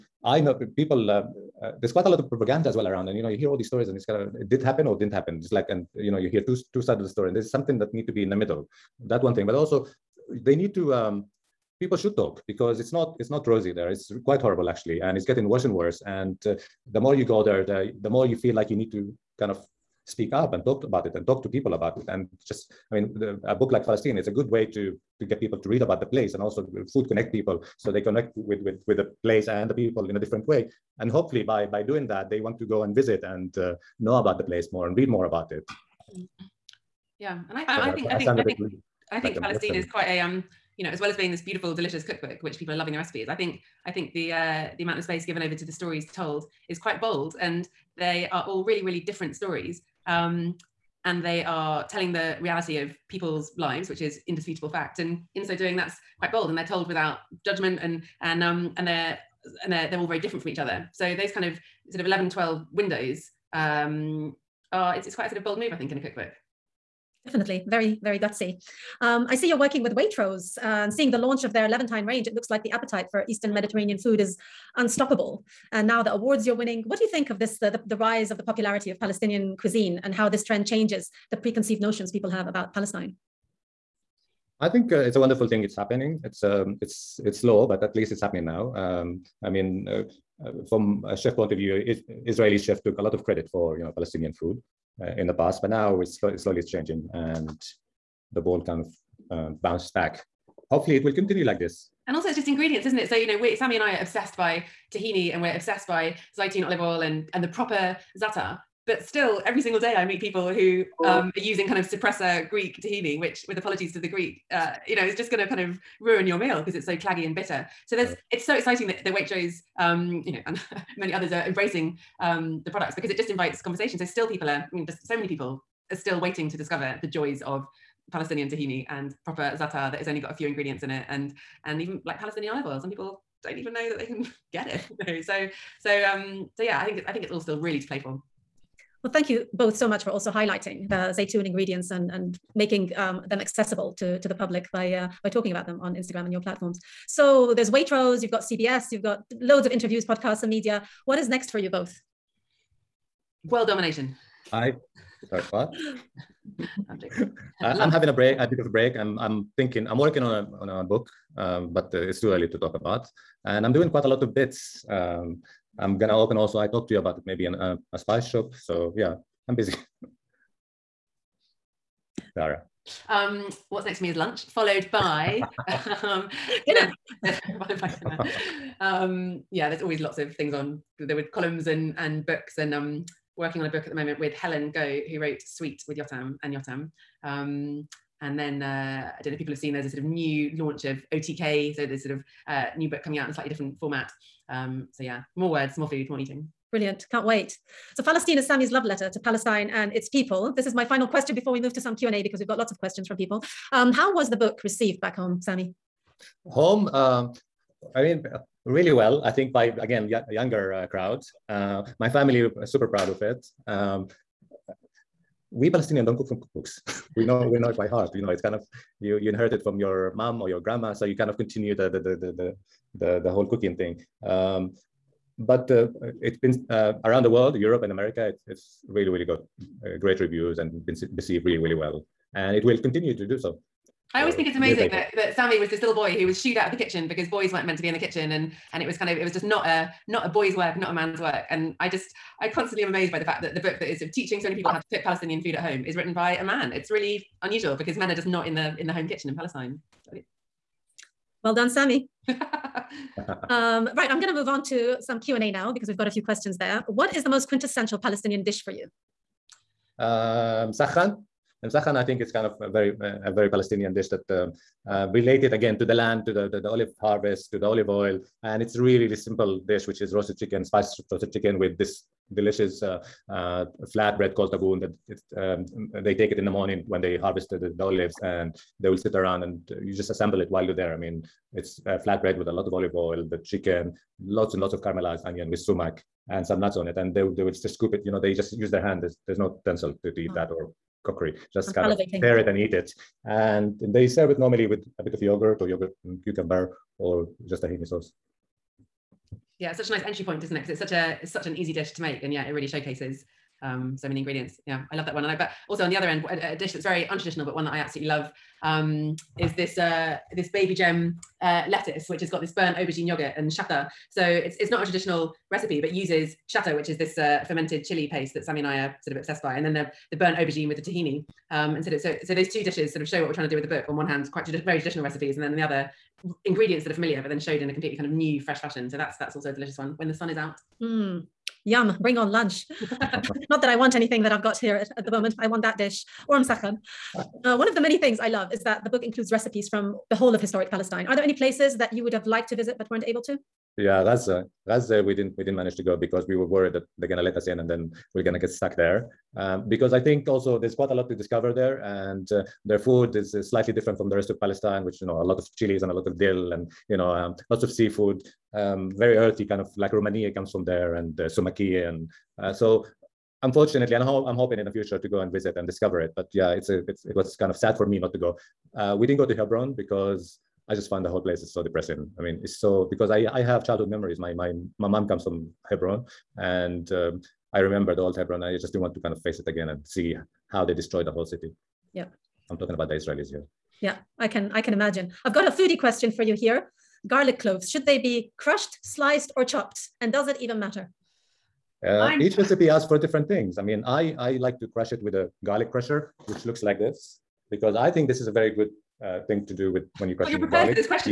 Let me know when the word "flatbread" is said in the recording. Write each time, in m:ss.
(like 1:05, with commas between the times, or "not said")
4:41.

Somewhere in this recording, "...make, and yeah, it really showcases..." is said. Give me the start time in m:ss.
5:02.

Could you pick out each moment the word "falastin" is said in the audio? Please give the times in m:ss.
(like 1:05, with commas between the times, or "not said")
0:23, 0:39, 3:18.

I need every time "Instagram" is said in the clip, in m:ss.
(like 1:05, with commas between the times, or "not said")
2:25.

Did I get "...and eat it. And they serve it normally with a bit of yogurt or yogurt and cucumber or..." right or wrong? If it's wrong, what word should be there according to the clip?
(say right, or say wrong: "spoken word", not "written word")
right.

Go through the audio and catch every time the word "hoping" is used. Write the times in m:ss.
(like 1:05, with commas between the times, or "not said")
6:04.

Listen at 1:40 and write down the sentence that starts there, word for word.
Hopefully, it will continue like this.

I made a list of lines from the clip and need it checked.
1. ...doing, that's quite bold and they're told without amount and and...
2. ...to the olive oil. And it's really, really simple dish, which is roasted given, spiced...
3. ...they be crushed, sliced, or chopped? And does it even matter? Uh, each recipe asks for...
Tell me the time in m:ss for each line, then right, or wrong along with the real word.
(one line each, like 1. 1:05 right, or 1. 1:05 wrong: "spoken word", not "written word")
1. 0:55 wrong: "judgment", not "amount"
2. 4:27 wrong: "chicken", not "given"
3. 6:27 right.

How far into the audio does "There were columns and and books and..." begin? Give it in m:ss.
3:00.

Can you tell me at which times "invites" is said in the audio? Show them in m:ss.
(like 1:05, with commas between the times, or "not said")
2:03.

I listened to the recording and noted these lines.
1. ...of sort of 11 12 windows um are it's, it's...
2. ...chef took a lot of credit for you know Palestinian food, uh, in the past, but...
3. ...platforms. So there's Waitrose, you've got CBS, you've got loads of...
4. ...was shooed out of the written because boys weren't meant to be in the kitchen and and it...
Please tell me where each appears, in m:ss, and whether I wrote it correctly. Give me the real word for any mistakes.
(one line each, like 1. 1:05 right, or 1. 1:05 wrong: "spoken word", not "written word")
1. 1:01 right
2. 1:32 right
3. 2:26 right
4. 3:56 wrong: "kitchen", not "written".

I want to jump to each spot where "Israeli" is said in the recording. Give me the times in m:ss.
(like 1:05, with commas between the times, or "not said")
1:32, 6:22.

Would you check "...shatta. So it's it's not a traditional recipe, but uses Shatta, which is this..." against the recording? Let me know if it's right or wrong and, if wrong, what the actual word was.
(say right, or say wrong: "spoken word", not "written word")
right.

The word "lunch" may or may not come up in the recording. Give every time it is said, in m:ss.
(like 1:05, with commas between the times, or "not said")
2:54, 5:32.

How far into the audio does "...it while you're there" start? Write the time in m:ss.
4:40.